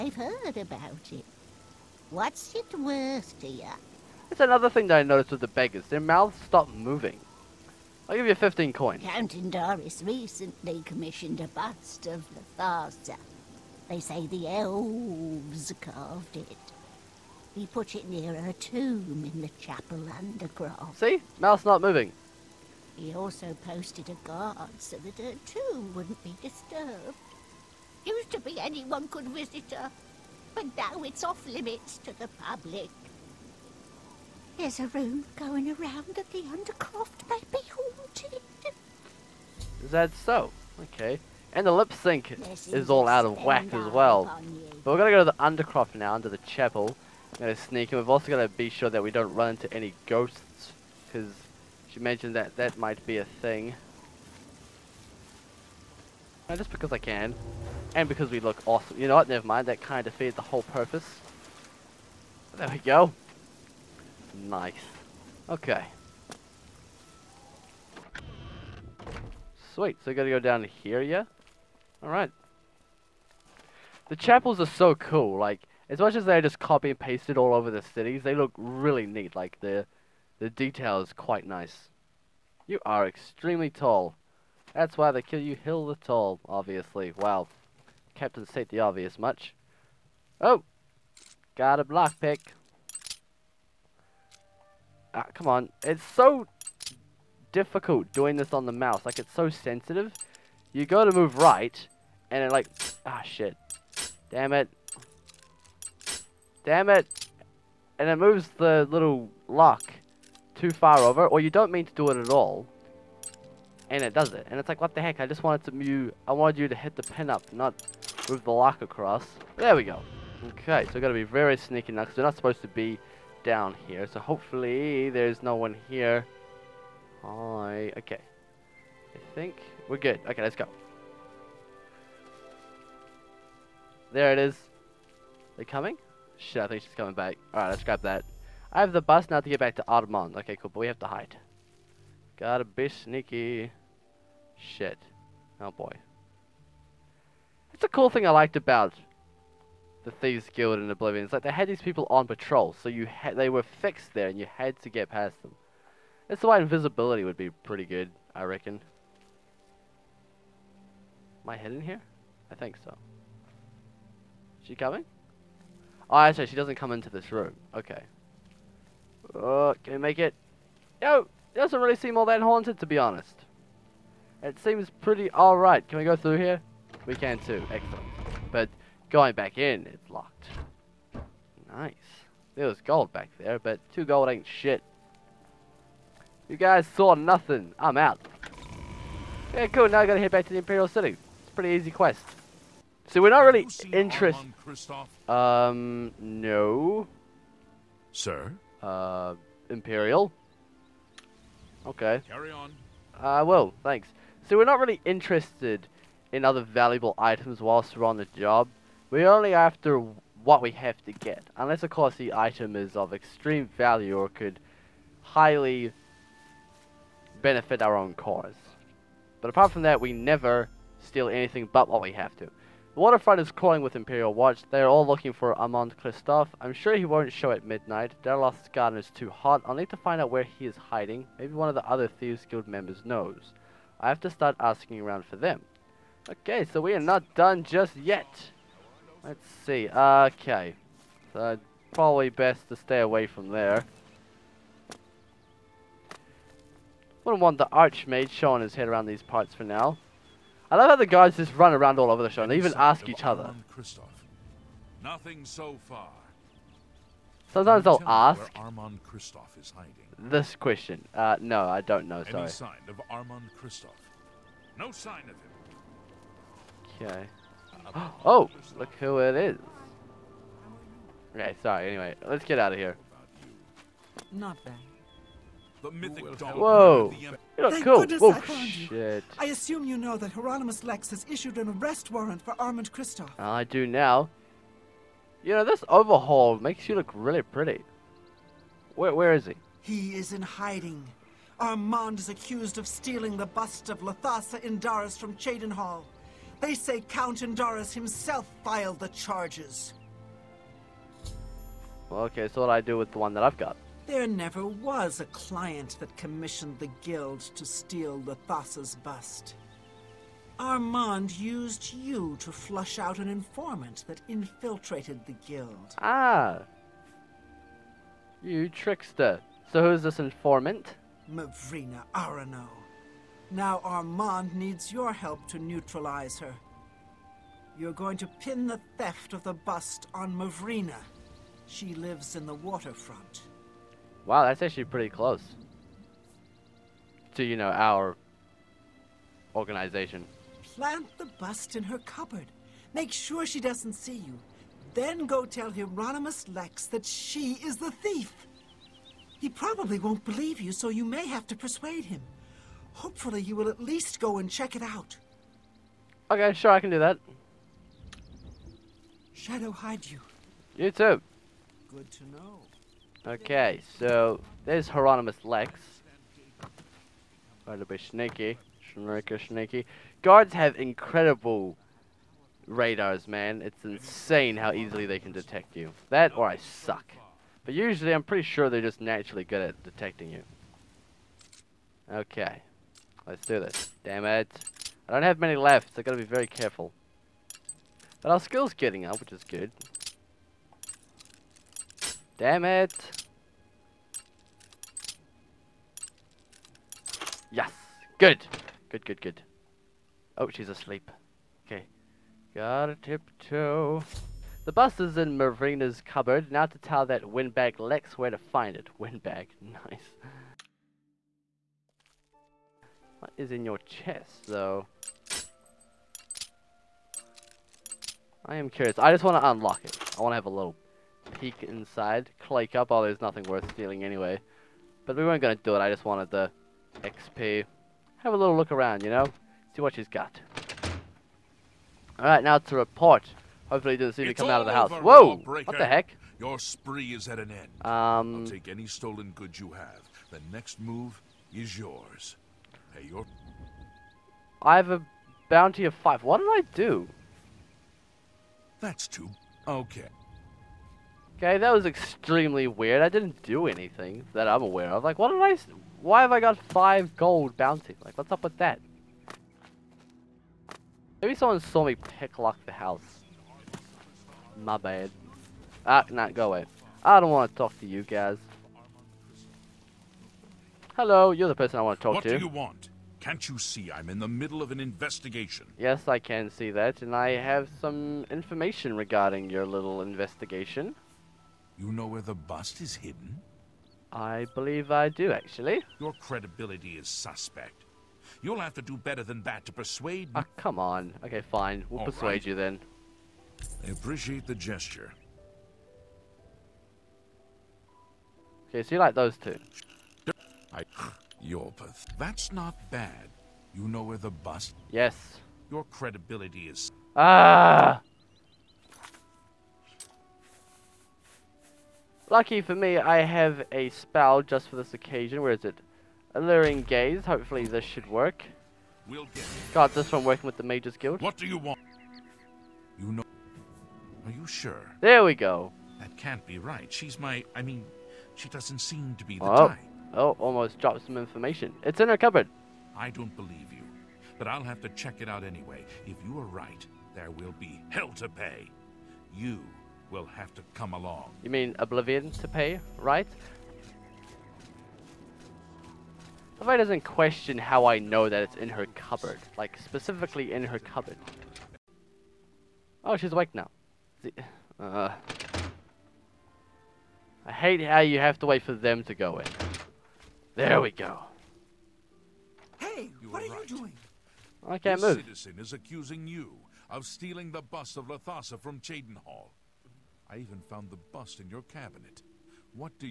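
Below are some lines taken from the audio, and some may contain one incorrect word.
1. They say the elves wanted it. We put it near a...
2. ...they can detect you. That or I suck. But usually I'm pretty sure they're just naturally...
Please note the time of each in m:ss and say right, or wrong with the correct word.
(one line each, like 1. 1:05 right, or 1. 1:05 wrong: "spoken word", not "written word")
1. 0:13 wrong: "carved", not "wanted"
2. 6:15 right.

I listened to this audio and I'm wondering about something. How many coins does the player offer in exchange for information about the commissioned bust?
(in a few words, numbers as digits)
15.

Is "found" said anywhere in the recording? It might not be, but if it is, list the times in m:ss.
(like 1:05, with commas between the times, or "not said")
4:38, 9:30.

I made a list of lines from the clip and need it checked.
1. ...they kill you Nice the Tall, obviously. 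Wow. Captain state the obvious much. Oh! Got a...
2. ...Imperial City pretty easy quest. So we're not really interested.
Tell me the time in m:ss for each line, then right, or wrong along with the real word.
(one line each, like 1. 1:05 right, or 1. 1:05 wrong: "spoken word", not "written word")
1. 1:25 wrong: "Hill", not "Nice"
2. 3:10 right.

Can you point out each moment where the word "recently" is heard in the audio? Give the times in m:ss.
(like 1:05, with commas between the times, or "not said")
0:10.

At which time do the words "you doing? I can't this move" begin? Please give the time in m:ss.
9:23.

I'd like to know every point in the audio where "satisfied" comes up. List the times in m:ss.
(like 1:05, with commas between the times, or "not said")
not said.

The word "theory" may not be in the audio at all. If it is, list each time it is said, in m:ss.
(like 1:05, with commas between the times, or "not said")
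not said.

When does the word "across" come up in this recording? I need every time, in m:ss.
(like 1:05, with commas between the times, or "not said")
1:58.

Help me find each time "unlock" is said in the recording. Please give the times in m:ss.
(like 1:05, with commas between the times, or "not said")
6:59.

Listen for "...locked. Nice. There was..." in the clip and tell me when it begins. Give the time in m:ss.
3:00.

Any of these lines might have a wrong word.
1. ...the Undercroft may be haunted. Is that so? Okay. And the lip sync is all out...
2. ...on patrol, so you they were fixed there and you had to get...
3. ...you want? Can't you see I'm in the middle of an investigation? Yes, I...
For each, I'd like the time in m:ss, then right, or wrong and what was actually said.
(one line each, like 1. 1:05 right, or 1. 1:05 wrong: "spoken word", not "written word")
1. 0:36 right
2. 2:32 right
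3. 7:52 right.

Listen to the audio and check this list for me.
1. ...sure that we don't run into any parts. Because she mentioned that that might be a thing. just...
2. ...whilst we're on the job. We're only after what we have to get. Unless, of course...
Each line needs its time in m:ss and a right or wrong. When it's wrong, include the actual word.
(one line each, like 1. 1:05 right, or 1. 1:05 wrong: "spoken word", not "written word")
1. 0:48 wrong: "ghosts", not "parts"
2. 3:27 right.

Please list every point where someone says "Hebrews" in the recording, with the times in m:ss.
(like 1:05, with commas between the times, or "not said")
not said.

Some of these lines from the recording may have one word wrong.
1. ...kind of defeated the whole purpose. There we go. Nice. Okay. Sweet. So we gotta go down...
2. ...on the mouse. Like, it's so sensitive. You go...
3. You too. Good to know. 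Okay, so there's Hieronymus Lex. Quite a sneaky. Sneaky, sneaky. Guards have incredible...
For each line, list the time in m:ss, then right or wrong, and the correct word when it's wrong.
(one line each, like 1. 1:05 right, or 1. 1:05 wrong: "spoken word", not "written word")
1. 0:59 right
2. 1:38 right
3. 6:00 right.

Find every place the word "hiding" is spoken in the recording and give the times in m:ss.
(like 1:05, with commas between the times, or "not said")
3:50, 4:19, 4:50.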